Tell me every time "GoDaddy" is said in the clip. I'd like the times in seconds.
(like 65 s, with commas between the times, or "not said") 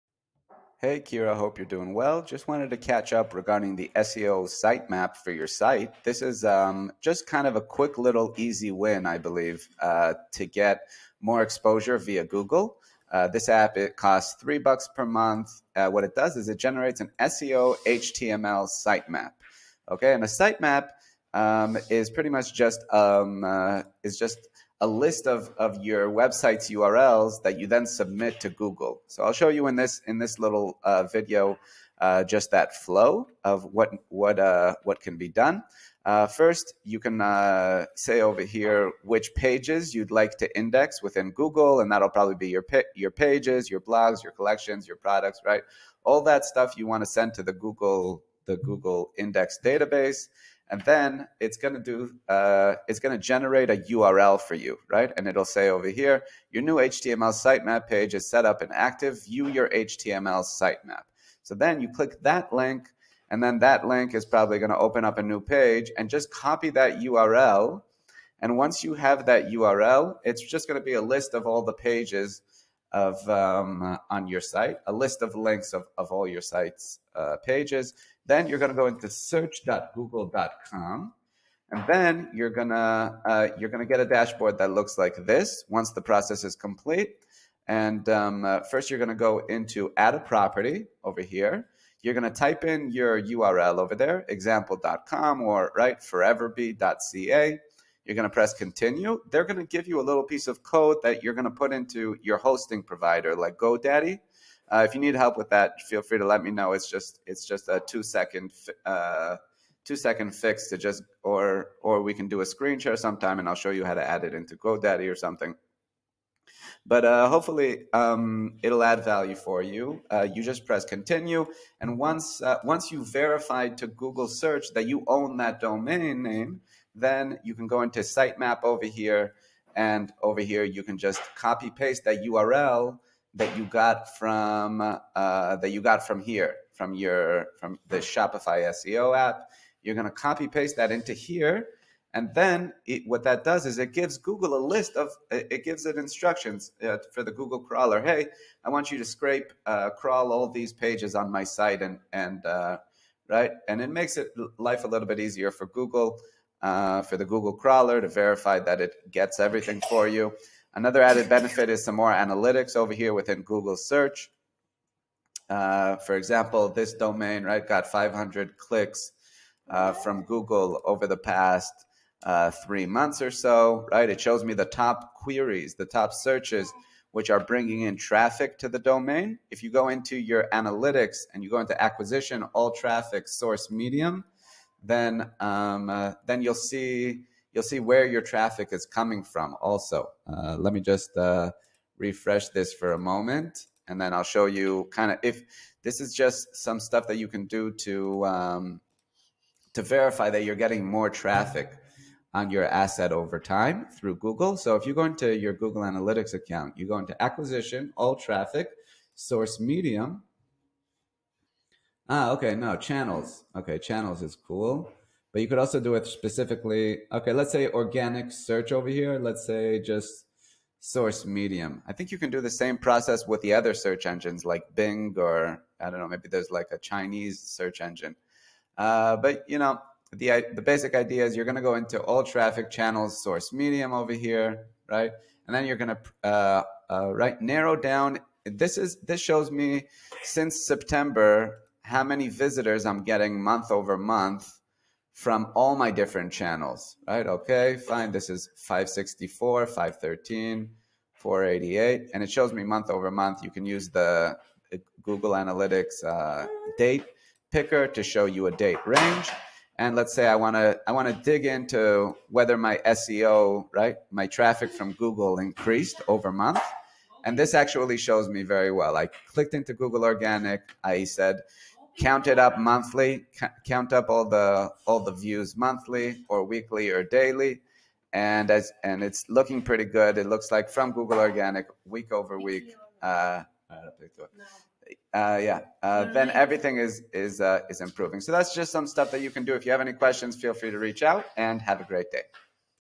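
103 s, 114 s.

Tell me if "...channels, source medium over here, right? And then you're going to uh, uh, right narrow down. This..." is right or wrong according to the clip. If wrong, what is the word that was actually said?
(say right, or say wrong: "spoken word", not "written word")
right.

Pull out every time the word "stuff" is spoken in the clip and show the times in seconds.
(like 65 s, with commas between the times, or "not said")
46 s, 196 s, 288 s.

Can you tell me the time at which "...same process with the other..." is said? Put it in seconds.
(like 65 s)
222 s.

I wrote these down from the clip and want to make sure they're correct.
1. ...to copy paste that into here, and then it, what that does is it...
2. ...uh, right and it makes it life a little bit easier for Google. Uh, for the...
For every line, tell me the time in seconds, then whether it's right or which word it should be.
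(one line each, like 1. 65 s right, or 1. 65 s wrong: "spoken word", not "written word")
1. 140 s right
2. 152 s right.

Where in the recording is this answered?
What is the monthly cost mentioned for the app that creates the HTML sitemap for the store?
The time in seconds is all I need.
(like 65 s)
14 s.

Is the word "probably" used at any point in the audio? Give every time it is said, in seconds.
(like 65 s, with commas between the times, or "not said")
42 s, 64 s.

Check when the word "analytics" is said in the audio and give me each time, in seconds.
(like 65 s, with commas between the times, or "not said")
162 s, 180 s, 205 s, 255 s.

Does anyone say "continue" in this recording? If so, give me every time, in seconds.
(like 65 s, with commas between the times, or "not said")
98 s, 120 s.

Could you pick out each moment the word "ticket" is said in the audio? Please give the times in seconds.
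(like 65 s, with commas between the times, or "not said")
not said.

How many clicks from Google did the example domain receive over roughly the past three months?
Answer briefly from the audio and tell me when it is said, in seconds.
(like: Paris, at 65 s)
500, at 167 s.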